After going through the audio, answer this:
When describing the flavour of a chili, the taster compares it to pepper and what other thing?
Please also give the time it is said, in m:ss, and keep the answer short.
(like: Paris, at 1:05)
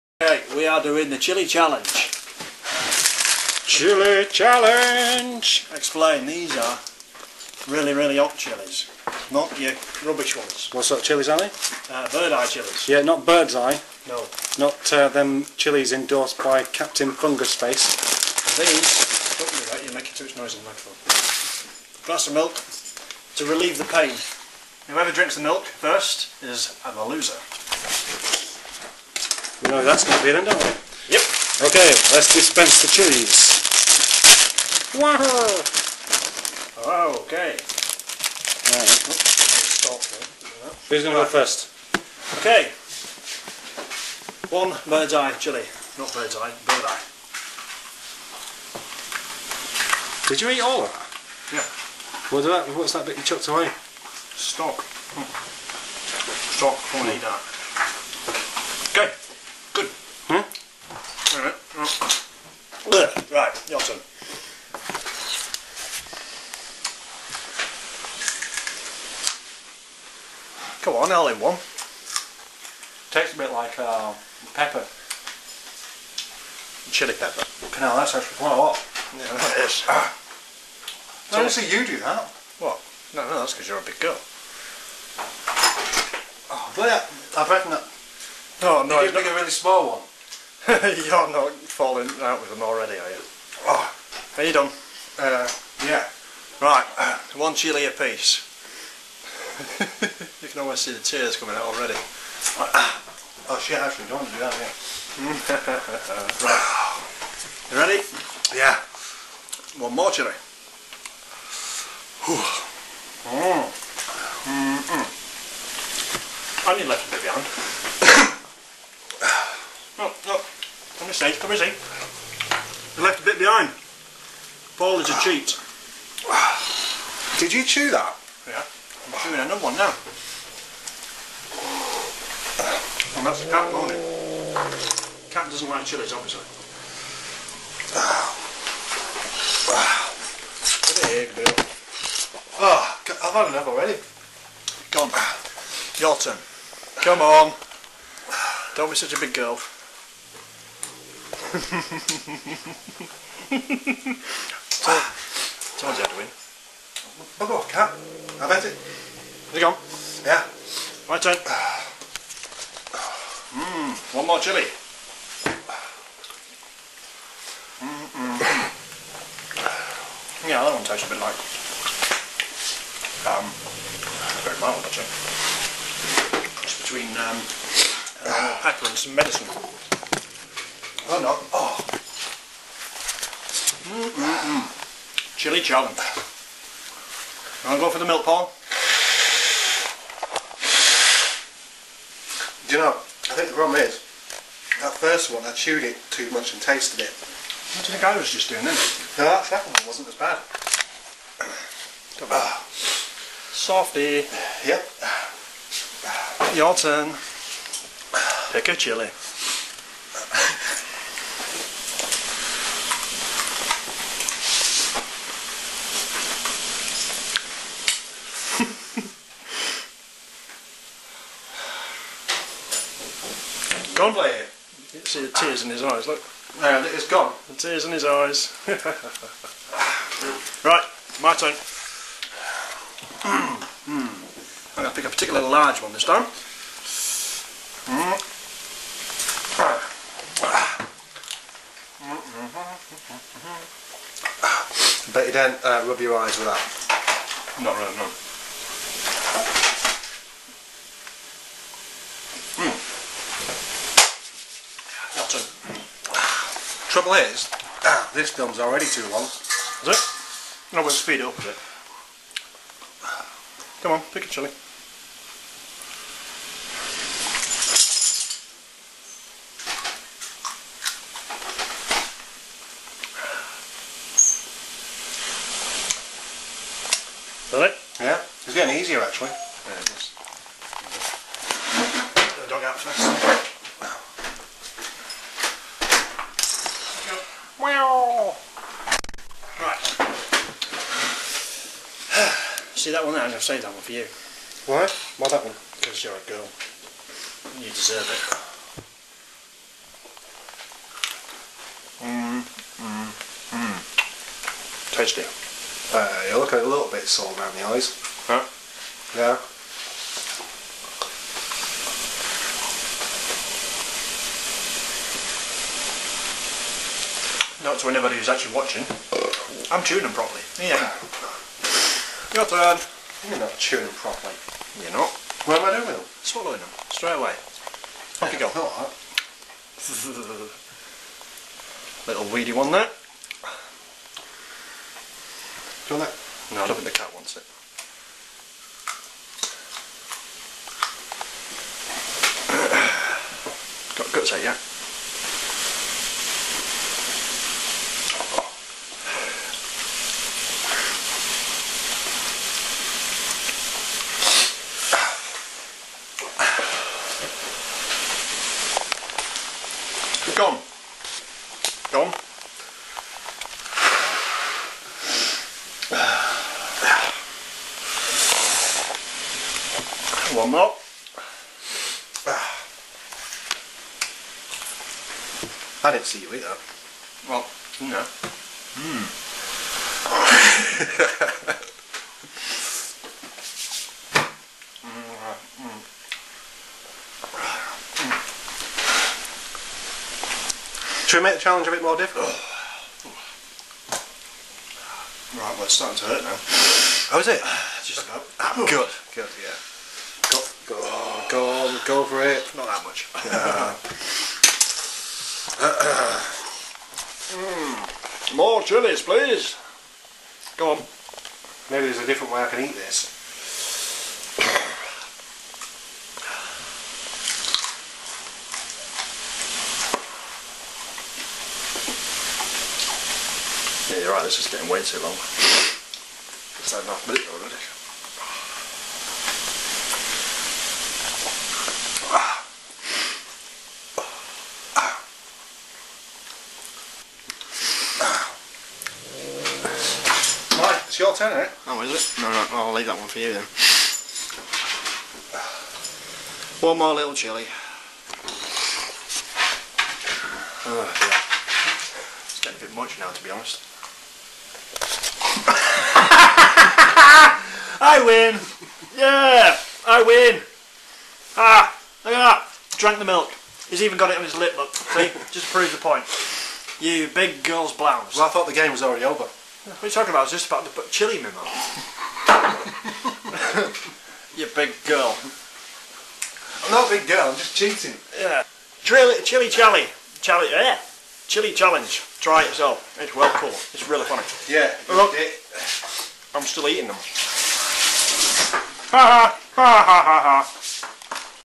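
Medicine, at 2:58.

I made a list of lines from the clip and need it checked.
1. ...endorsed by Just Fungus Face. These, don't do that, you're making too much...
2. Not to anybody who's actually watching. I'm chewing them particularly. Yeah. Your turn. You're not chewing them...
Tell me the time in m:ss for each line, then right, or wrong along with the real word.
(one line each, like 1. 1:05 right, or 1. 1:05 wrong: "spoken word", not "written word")
1. 0:15 wrong: "Captain", not "Just"
2. 5:17 wrong: "properly", not "particularly".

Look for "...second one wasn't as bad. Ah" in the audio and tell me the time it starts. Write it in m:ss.
3:19.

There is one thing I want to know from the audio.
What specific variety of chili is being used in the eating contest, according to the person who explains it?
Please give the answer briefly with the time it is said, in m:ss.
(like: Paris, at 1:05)
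Bird eye chilies, at 0:12.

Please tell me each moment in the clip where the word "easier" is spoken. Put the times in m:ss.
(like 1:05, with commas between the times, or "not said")
4:38.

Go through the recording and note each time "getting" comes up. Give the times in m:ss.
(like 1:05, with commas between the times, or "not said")
4:38, 7:04, 7:32.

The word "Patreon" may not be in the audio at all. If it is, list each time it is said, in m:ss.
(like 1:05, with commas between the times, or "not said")
not said.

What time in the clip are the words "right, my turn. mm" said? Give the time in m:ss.
3:50.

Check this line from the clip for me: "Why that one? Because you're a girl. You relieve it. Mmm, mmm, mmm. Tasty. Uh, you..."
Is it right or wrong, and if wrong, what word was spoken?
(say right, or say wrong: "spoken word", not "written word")
wrong: "deserve", not "relieve".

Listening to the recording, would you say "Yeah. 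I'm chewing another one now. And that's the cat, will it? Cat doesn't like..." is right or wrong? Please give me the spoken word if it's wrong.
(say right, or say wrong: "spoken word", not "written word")
right.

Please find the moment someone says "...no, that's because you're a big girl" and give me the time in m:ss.
1:23.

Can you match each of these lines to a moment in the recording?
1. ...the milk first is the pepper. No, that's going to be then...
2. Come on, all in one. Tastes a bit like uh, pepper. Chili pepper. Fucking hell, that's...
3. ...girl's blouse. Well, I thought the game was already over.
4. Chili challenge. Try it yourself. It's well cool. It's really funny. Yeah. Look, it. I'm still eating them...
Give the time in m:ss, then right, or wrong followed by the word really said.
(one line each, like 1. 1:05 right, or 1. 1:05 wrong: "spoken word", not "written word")
1. 0:25 wrong: "loser", not "pepper"
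2. 1:10 right
3. 7:47 right
4. 8:01 right.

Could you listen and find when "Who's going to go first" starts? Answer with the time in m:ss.
0:40.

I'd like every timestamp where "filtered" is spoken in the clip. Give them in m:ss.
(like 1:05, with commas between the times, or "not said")
not said.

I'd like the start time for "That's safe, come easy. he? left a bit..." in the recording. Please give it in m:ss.
2:01.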